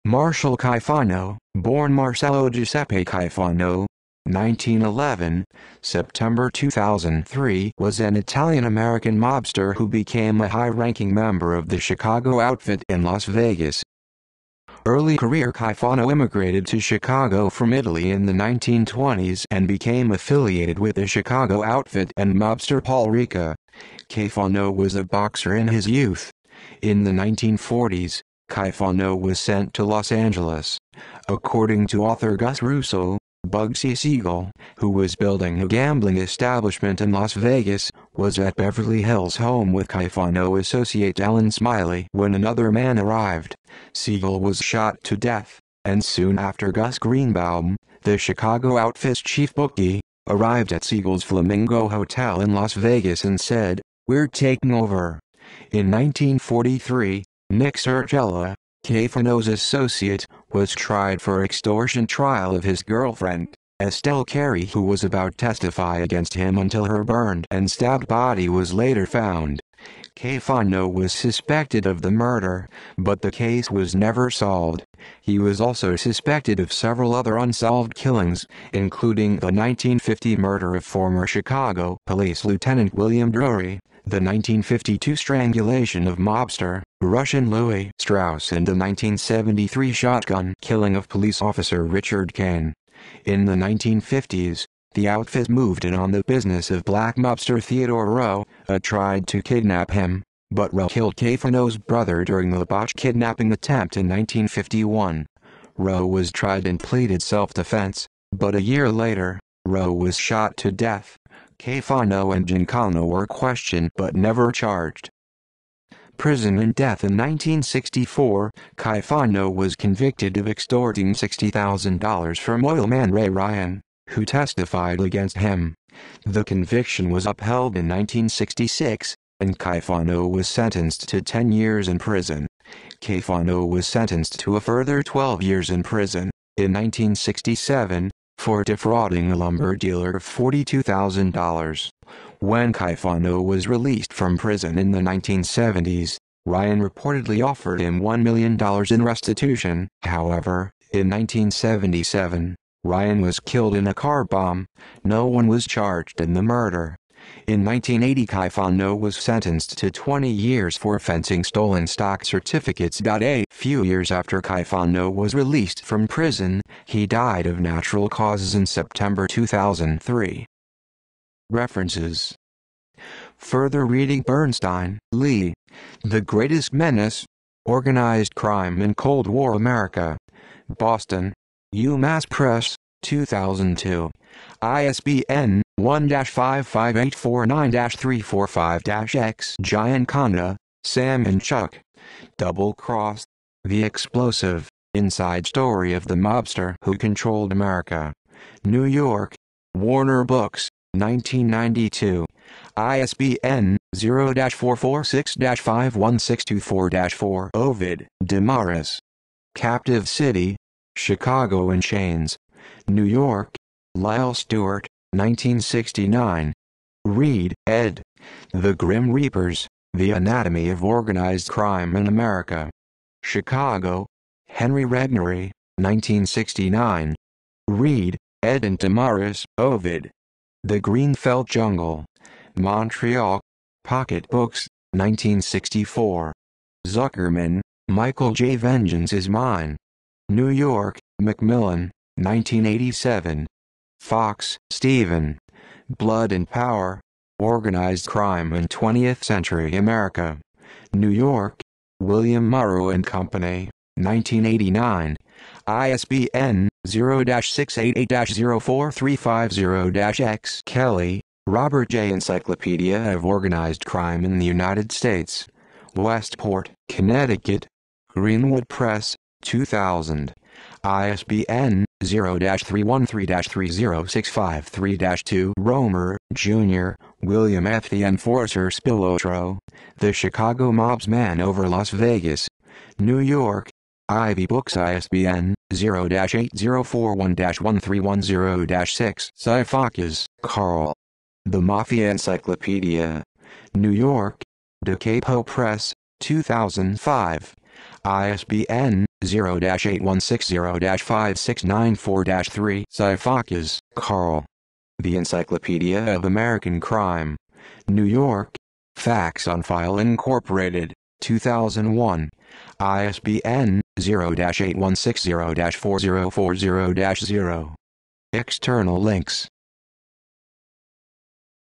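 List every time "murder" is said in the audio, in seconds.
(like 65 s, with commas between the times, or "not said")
72 s, 80 s, 156 s.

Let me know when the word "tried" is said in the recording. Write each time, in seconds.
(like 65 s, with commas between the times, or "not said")
60 s, 98 s, 106 s.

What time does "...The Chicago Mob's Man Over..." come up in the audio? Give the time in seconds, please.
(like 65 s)
279 s.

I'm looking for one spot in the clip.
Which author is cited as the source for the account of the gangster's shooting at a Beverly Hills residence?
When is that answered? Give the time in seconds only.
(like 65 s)
32 s.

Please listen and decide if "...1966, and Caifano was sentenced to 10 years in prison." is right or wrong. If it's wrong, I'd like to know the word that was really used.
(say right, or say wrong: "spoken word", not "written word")
right.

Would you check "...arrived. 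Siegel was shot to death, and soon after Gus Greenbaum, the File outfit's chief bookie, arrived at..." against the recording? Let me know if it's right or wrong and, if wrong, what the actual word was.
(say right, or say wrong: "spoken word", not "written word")
wrong: "Chicago", not "File".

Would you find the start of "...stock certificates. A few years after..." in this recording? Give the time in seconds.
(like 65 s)
161 s.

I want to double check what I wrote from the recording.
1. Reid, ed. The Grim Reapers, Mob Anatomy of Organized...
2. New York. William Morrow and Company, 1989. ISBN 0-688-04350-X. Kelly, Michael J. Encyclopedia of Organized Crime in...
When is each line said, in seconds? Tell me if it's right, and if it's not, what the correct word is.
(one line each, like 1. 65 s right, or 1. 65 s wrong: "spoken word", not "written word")
1. 217 s wrong: "The", not "Mob"
2. 250 s wrong: "Robert", not "Michael".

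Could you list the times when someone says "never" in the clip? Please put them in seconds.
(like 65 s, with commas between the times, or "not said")
73 s, 114 s.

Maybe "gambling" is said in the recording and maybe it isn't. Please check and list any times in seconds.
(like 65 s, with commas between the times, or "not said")
35 s.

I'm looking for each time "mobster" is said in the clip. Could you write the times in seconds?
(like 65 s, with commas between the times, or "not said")
9 s, 22 s, 86 s, 97 s, 196 s.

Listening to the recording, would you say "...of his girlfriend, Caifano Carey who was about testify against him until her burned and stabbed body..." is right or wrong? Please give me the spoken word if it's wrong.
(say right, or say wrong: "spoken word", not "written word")
wrong: "Estelle", not "Caifano".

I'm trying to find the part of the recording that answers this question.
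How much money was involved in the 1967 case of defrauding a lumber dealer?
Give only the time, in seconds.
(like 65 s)
140 s.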